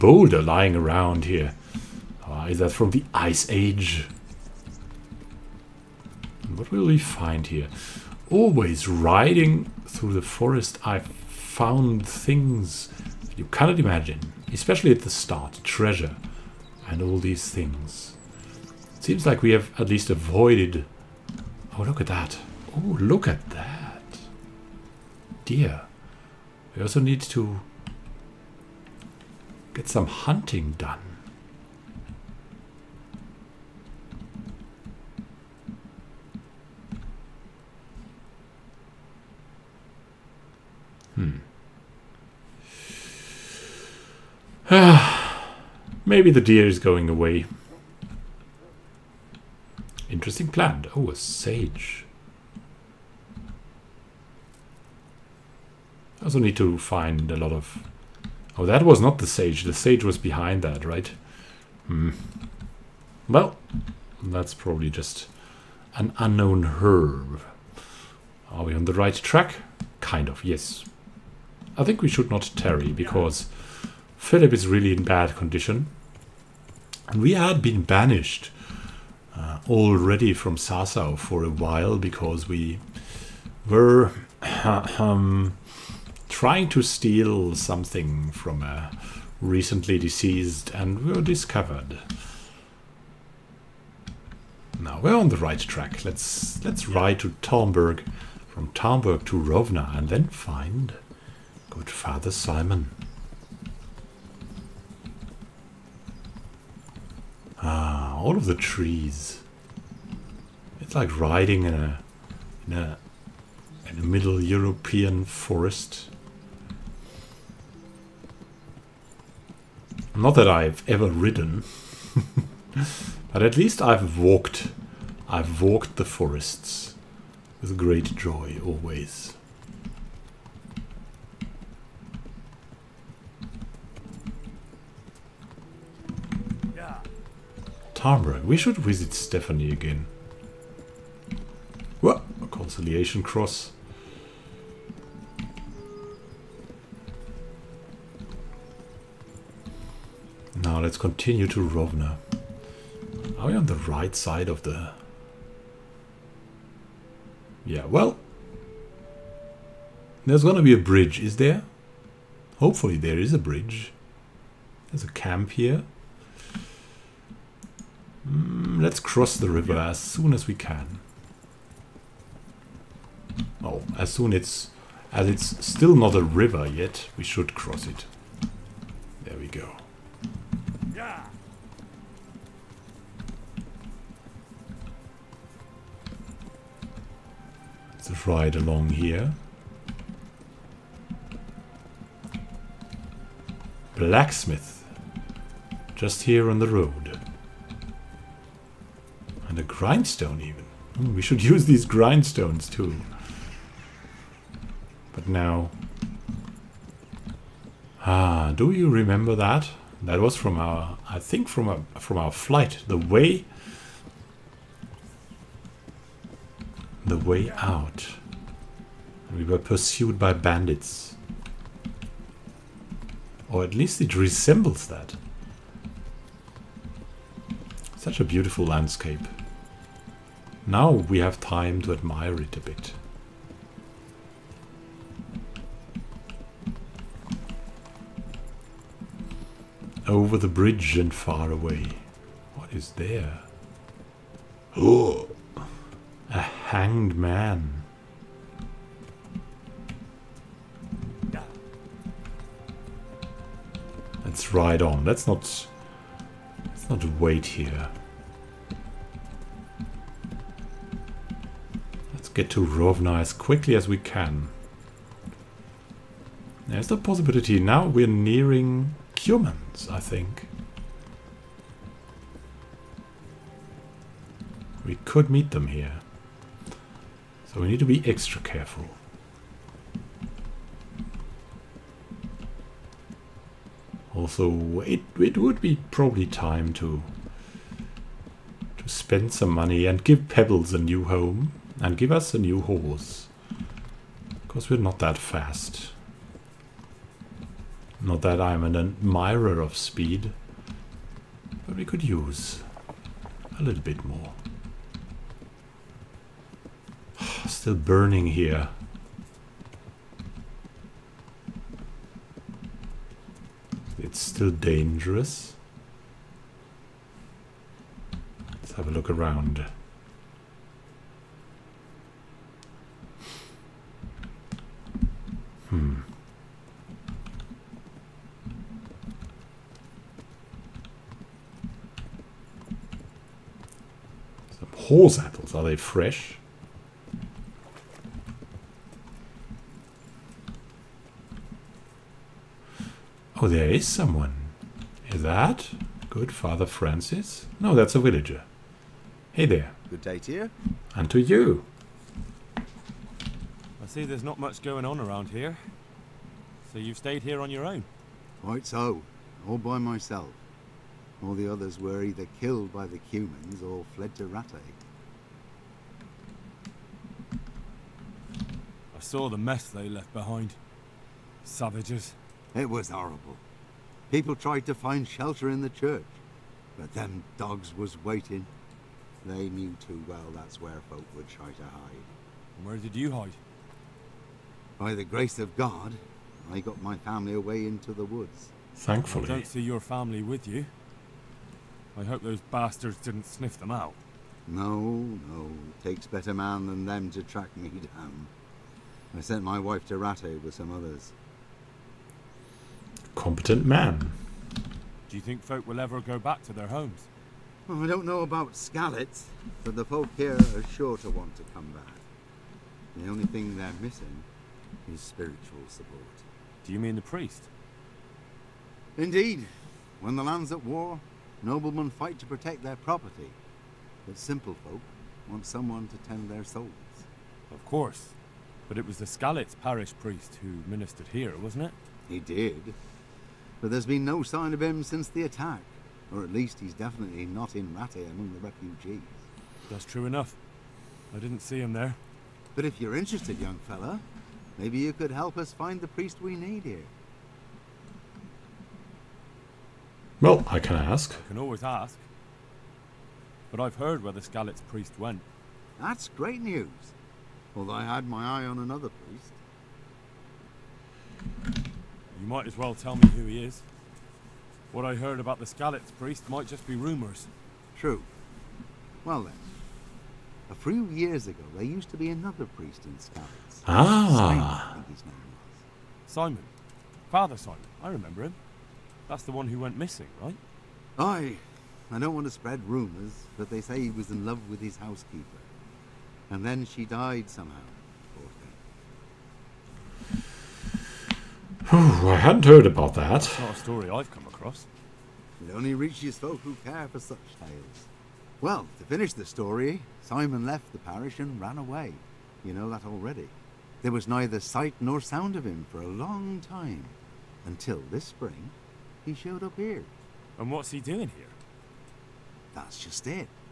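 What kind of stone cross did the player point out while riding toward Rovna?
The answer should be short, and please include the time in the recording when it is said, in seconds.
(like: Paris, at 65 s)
A conciliation cross, at 142 s.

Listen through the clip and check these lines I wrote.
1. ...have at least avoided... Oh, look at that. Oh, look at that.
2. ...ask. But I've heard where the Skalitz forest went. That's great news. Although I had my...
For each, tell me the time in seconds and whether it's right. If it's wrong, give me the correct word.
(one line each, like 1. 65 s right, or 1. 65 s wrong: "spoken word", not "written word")
1. 19 s right
2. 451 s wrong: "priest", not "forest".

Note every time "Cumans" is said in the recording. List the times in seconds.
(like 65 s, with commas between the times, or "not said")
269 s, 362 s.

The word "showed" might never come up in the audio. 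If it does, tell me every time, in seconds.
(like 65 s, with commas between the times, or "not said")
509 s.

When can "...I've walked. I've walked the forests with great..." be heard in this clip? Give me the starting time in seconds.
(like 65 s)
123 s.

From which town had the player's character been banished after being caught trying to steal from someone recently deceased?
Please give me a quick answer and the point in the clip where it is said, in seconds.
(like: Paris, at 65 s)
Sasau, at 80 s.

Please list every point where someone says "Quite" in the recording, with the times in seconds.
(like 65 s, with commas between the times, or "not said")
358 s.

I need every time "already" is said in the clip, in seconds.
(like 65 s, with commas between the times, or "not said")
79 s, 502 s.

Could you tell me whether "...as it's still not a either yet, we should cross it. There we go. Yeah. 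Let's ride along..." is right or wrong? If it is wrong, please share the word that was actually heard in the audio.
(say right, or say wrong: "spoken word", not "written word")
wrong: "river", not "either".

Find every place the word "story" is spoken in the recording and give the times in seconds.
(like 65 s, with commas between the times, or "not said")
493 s, 499 s.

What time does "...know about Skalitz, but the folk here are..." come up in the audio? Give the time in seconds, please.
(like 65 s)
408 s.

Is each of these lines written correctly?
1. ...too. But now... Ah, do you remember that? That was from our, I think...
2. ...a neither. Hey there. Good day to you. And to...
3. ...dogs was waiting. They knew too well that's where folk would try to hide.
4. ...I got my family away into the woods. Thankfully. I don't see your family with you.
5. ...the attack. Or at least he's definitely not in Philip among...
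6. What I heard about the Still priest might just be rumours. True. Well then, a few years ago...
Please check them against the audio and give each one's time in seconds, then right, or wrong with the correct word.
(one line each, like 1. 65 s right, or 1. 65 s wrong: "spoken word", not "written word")
1. 202 s right
2. 347 s wrong: "villager", not "neither"
3. 377 s right
4. 386 s right
5. 435 s wrong: "Rattay", not "Philip"
6. 464 s wrong: "Skalitz", not "Still".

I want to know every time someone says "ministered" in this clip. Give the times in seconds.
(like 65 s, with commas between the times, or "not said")
430 s.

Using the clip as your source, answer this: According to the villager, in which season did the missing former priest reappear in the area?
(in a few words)
Spring.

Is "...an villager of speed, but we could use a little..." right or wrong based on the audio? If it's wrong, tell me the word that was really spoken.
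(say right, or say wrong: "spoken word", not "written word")
wrong: "admirer", not "villager".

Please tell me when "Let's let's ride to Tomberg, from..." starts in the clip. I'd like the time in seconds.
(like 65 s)
96 s.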